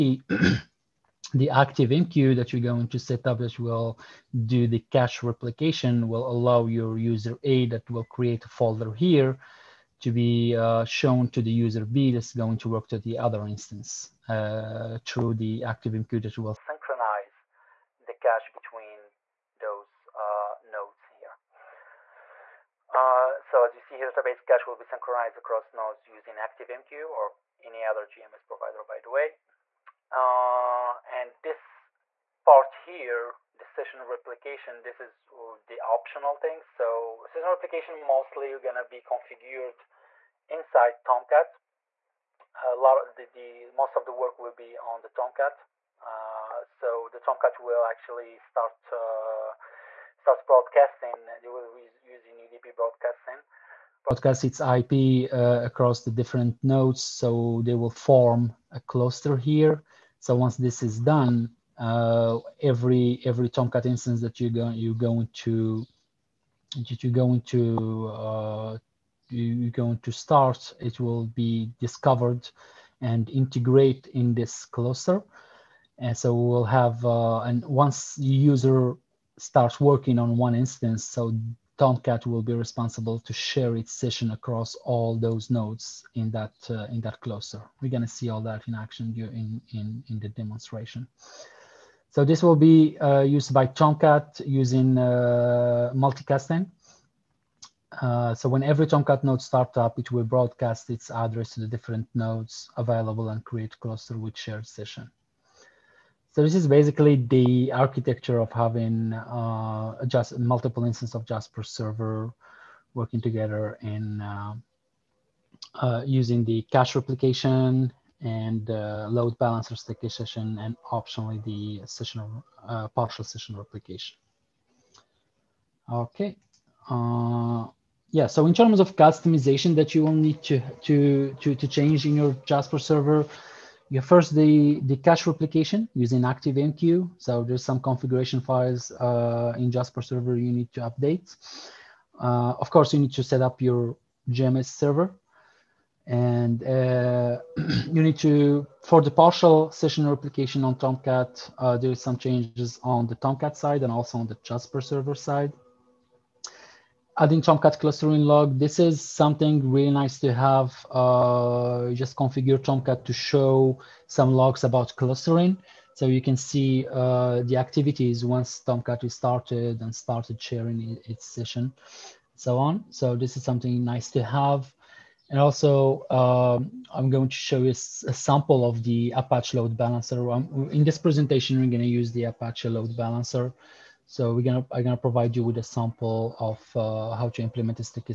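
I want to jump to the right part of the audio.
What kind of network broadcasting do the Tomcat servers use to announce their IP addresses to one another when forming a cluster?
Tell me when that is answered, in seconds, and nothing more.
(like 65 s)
52 s.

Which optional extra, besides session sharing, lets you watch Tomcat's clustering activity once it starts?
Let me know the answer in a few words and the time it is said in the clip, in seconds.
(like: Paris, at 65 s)
Tomcat clustering log, at 157 s.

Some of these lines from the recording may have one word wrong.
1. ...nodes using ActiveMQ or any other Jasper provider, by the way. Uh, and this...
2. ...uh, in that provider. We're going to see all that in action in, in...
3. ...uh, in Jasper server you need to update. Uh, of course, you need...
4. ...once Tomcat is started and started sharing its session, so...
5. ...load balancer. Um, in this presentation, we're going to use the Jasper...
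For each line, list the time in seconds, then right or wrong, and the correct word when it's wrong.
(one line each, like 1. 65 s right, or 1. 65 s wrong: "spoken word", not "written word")
1. 25 s wrong: "JMS", not "Jasper"
2. 86 s wrong: "cluster", not "provider"
3. 138 s right
4. 168 s right
5. 179 s wrong: "Apache", not "Jasper".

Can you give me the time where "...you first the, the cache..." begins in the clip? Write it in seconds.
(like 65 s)
133 s.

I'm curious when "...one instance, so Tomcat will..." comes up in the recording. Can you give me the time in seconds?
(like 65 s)
80 s.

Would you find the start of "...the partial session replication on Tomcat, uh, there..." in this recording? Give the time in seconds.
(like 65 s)
149 s.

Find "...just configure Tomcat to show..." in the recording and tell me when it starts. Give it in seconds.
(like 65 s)
161 s.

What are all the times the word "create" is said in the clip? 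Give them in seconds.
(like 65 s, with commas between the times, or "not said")
8 s, 103 s.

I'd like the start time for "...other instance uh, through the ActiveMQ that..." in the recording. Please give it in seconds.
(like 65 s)
13 s.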